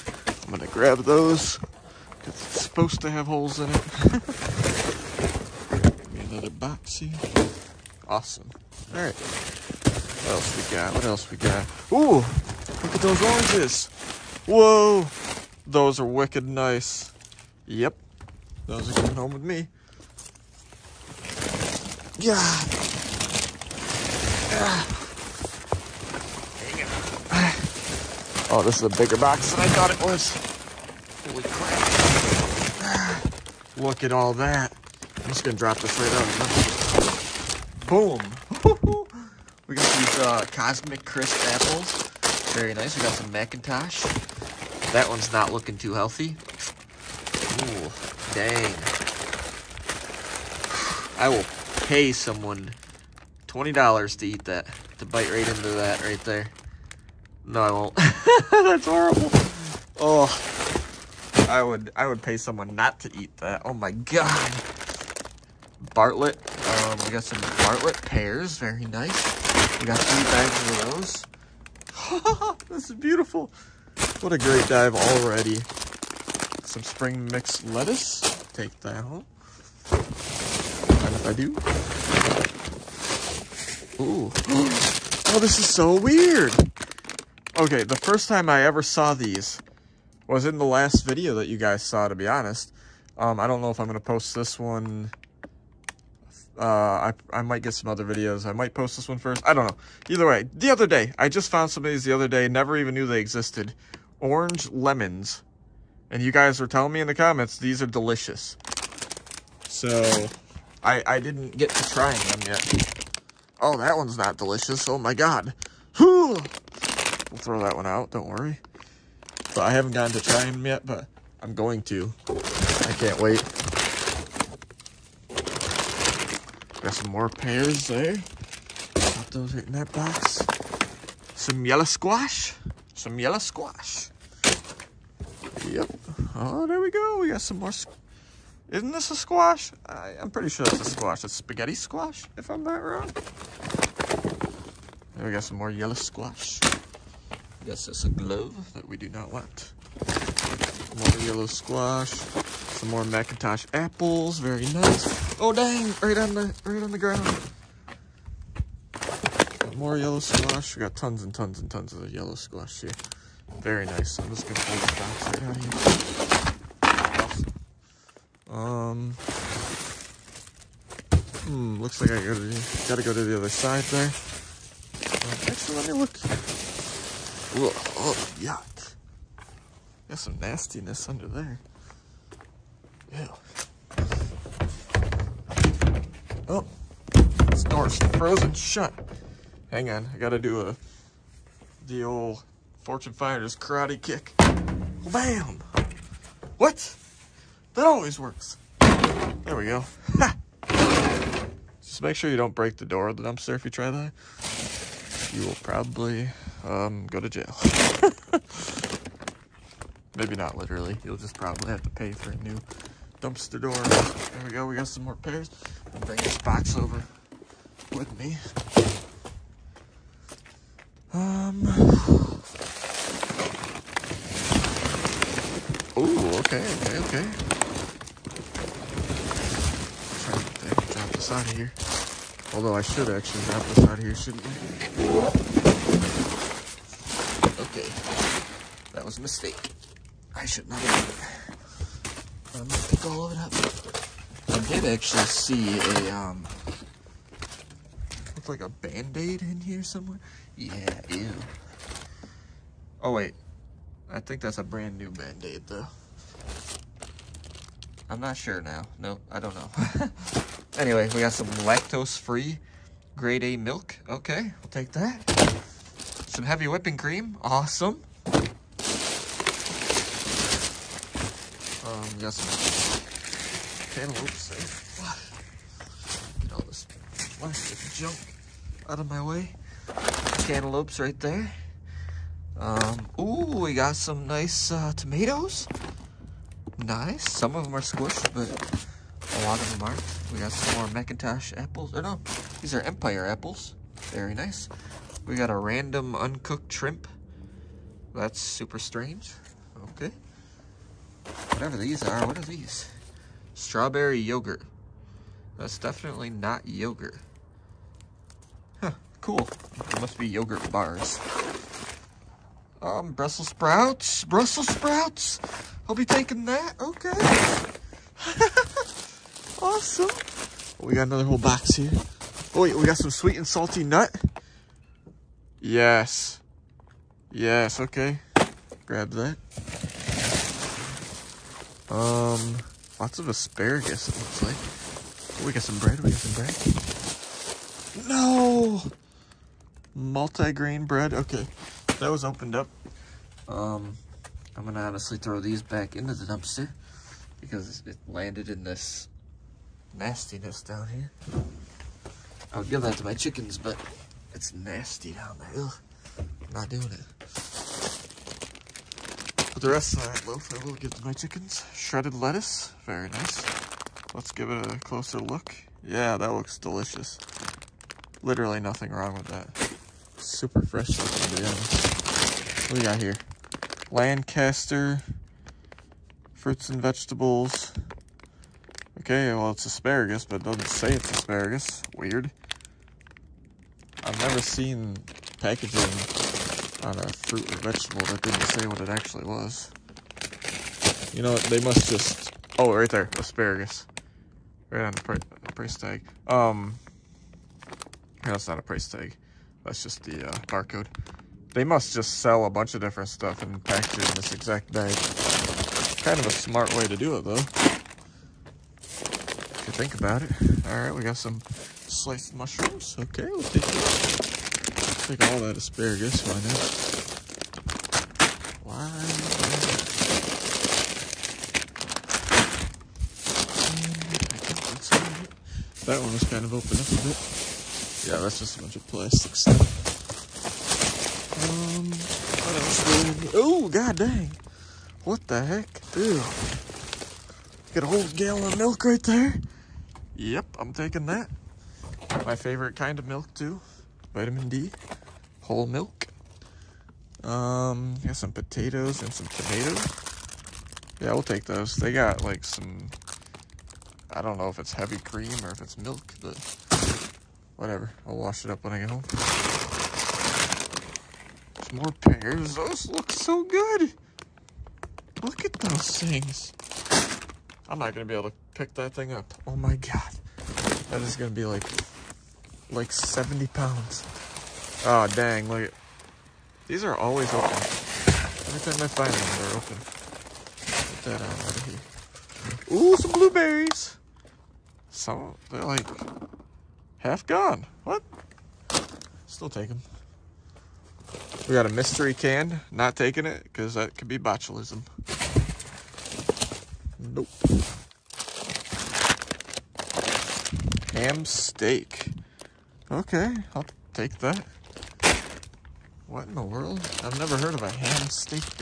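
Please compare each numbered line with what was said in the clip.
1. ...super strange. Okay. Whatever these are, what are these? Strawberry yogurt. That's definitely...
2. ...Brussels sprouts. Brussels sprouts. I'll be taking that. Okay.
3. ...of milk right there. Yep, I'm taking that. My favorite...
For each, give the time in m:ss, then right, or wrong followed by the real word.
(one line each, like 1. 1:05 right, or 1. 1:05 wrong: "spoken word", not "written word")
1. 4:58 right
2. 5:13 right
3. 7:18 right.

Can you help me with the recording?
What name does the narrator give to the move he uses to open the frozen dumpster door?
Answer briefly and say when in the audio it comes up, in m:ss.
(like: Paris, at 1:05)
Fortune finder's karate kick, at 3:12.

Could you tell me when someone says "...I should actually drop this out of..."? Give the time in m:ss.
3:52.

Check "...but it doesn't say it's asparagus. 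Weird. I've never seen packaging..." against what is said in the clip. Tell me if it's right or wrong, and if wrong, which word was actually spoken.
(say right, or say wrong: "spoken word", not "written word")
right.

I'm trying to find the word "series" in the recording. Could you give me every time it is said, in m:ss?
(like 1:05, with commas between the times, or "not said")
not said.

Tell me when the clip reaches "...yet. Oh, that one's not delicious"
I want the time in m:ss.
1:52.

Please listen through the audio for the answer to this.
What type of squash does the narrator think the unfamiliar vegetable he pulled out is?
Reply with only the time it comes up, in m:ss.
2:21.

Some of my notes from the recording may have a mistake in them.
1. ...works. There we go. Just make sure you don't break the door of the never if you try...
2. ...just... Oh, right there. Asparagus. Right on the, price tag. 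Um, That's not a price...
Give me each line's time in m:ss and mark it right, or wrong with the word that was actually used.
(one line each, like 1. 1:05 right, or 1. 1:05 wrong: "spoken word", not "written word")
1. 3:18 wrong: "dumpster", not "never"
2. 6:31 right.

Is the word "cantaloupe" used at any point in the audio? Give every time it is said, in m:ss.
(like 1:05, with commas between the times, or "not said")
4:33, 4:40.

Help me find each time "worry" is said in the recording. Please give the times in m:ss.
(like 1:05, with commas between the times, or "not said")
1:58.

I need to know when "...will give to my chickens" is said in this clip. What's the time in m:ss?
6:00.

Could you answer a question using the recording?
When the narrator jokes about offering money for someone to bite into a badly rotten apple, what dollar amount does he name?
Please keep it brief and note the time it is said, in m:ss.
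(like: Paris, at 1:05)
$20, at 0:53.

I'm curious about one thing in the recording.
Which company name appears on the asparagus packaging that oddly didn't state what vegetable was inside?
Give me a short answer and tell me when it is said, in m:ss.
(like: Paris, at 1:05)
Lancaster, at 6:13.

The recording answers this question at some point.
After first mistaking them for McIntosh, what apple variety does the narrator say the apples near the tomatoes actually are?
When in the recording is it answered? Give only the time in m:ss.
4:52.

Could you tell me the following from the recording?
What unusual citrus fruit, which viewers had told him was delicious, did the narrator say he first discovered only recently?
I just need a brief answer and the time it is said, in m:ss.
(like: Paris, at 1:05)
Orange lemons, at 1:44.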